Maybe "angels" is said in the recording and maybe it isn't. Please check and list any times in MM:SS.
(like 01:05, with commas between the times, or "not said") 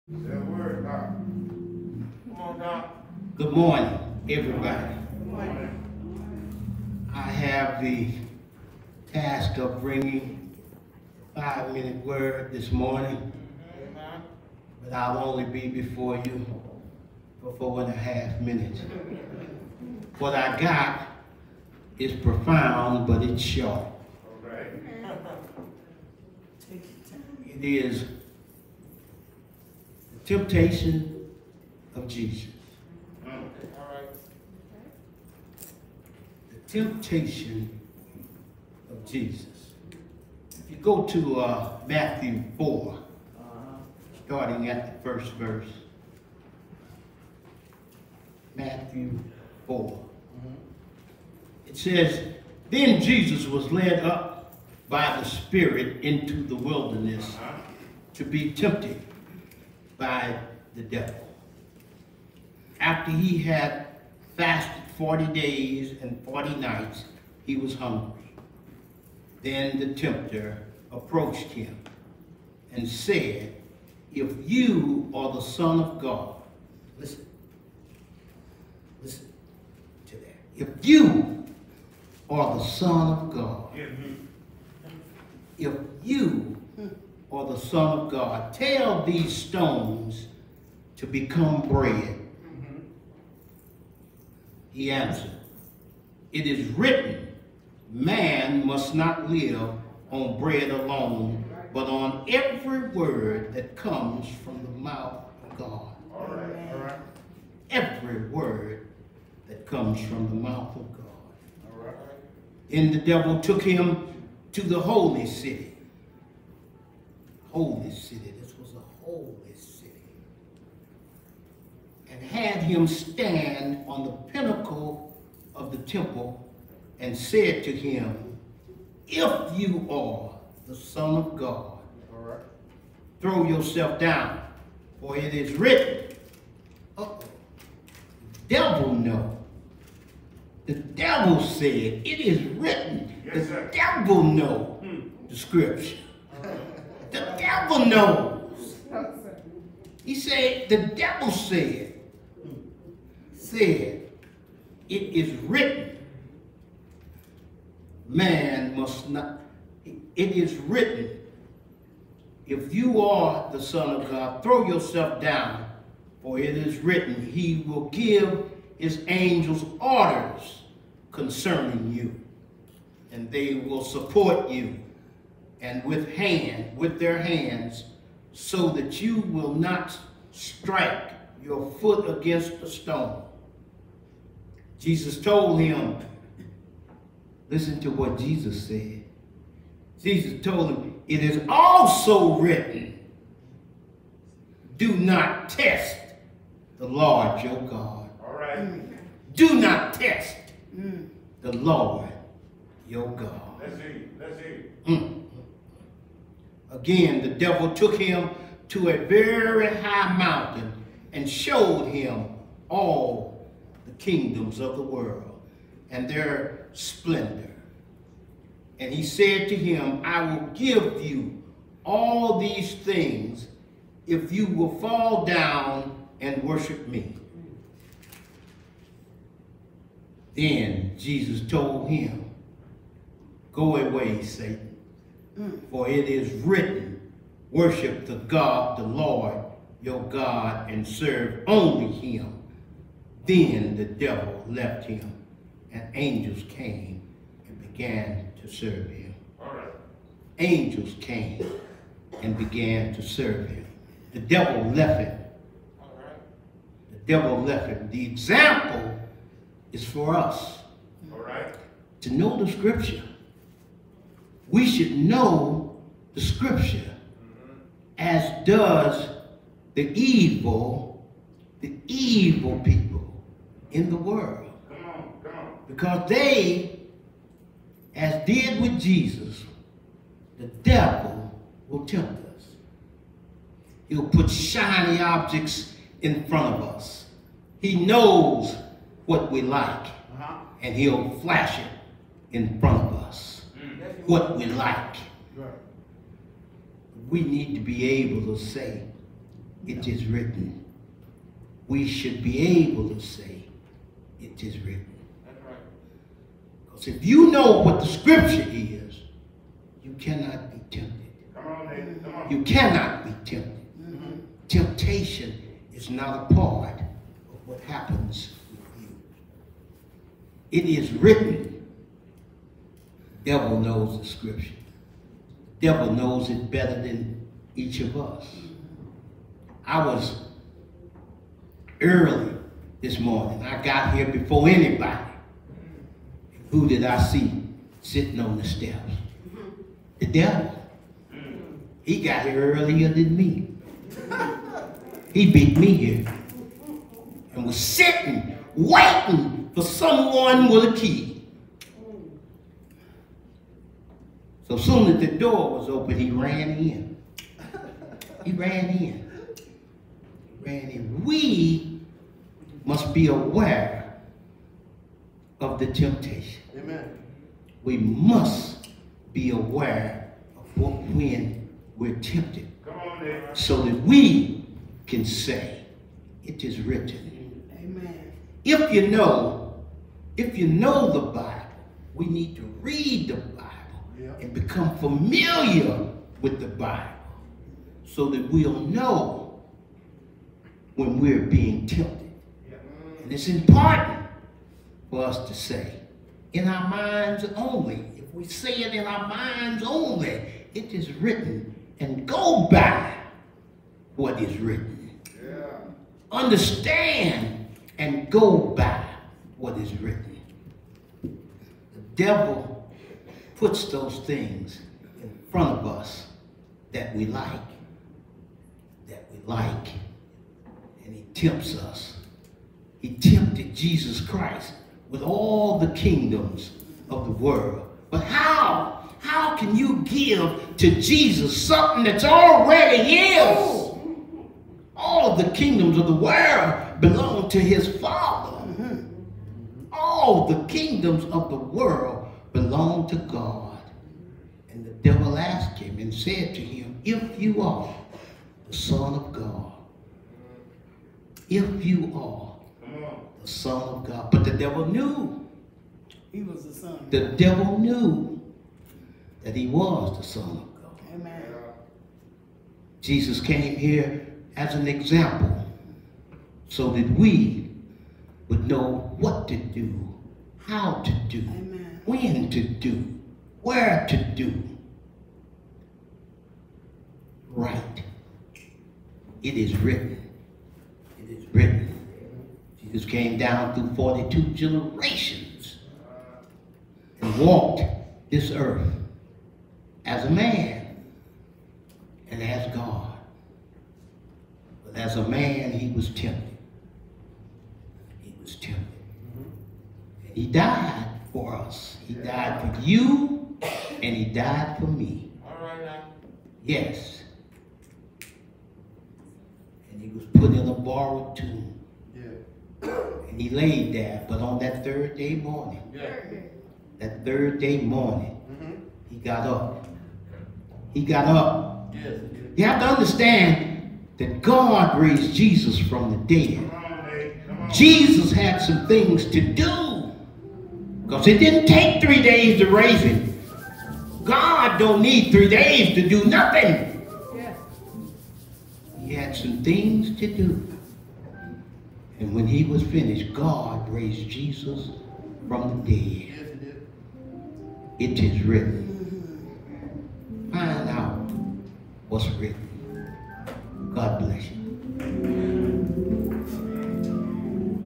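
02:49, 04:05, 04:10.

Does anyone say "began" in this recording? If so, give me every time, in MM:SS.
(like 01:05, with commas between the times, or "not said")
04:07, 04:12.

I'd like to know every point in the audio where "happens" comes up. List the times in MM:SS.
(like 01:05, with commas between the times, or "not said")
05:17.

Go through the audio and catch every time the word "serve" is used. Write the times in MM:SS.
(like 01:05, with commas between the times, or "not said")
04:00, 04:08, 04:13.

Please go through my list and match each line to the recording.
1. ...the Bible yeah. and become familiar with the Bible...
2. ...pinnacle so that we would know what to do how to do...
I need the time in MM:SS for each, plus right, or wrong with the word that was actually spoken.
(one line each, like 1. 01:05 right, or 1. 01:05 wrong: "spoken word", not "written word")
1. 06:23 right
2. 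07:44 wrong: "example", not "pinnacle".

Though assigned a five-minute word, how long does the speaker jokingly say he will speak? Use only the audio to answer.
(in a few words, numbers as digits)
4 and a half minutes.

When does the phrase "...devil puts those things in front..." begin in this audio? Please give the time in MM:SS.
06:51.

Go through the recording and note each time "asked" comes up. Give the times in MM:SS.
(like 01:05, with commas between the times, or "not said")
07:25.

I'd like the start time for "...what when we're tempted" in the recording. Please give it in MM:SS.
06:10.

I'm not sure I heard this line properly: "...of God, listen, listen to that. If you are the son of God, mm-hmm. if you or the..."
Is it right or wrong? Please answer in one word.
right.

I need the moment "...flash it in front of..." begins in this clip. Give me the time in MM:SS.
04:51.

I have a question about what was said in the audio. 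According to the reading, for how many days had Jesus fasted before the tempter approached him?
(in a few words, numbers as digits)
40.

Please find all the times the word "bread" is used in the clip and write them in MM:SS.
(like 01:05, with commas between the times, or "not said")
01:31, 01:40.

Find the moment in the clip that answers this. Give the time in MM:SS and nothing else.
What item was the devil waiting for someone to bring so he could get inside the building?
05:50.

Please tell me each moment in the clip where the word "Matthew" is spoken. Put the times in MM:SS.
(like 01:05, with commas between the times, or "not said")
00:41, 00:48.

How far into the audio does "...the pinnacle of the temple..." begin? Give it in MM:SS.
02:04.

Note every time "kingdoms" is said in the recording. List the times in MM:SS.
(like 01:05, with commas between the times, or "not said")
03:33, 07:05, 07:15, 07:20.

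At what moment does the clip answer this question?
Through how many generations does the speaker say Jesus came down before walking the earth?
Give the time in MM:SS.
08:03.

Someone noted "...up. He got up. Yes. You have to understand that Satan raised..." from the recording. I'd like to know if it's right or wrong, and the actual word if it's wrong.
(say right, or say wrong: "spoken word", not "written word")
wrong: "God", not "Satan".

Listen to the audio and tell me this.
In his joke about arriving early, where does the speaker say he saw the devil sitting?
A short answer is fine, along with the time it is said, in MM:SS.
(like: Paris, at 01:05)
On the steps, at 05:38.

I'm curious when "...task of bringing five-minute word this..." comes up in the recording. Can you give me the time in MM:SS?
00:09.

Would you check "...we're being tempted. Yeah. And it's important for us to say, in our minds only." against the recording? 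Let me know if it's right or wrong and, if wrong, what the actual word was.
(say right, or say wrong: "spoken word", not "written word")
right.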